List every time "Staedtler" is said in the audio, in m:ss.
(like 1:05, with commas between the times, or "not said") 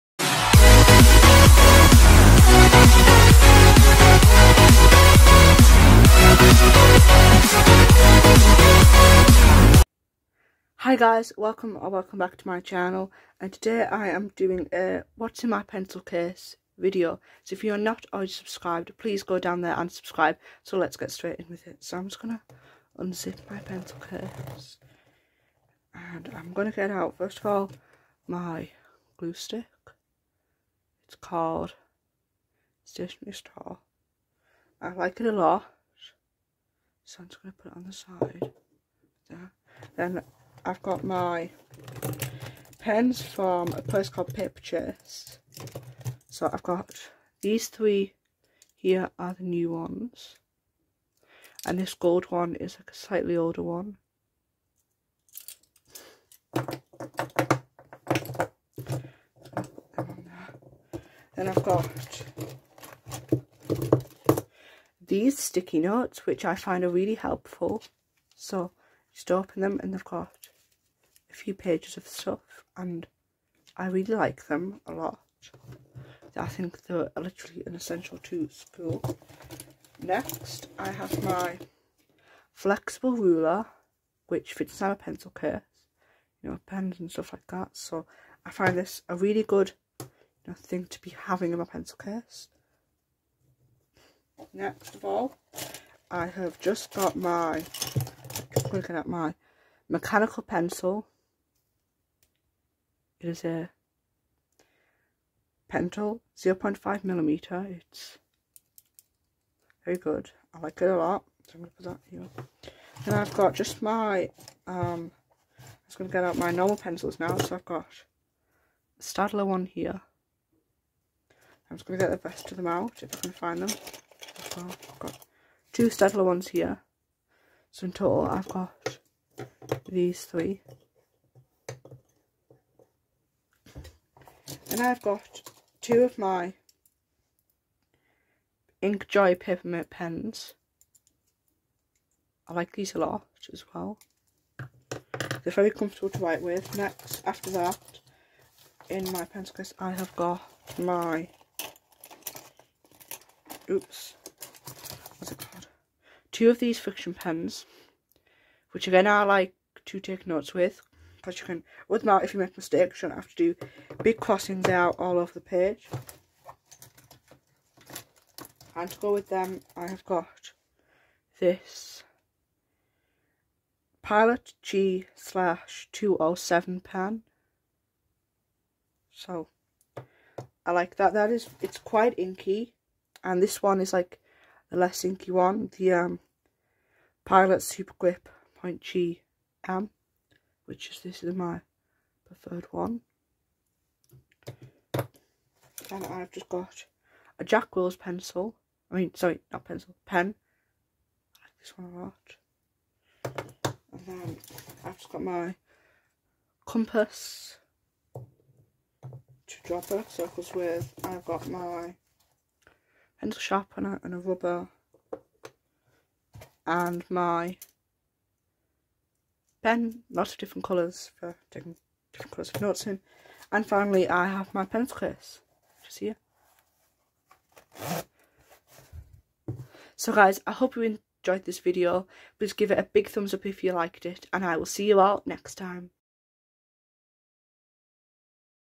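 1:59, 2:05.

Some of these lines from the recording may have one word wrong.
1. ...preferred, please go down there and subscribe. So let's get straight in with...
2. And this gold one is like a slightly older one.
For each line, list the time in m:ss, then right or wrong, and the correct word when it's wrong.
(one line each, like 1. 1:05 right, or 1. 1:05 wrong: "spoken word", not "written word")
1. 0:18 wrong: "subscribed", not "preferred"
2. 0:51 right.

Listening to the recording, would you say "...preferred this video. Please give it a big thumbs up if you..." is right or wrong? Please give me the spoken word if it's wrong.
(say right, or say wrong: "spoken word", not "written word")
wrong: "enjoyed", not "preferred".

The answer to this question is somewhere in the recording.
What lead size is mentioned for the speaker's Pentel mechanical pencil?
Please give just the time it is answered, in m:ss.
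1:46.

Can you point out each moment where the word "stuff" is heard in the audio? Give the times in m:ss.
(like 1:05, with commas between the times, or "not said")
1:12, 1:27.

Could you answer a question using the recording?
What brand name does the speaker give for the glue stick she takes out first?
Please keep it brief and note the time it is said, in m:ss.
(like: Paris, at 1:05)
Stationery Star, at 0:32.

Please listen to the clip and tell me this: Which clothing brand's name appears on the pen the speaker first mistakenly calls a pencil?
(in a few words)
Jack Wills.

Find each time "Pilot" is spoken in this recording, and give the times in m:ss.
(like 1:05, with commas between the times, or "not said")
2:54, 3:07.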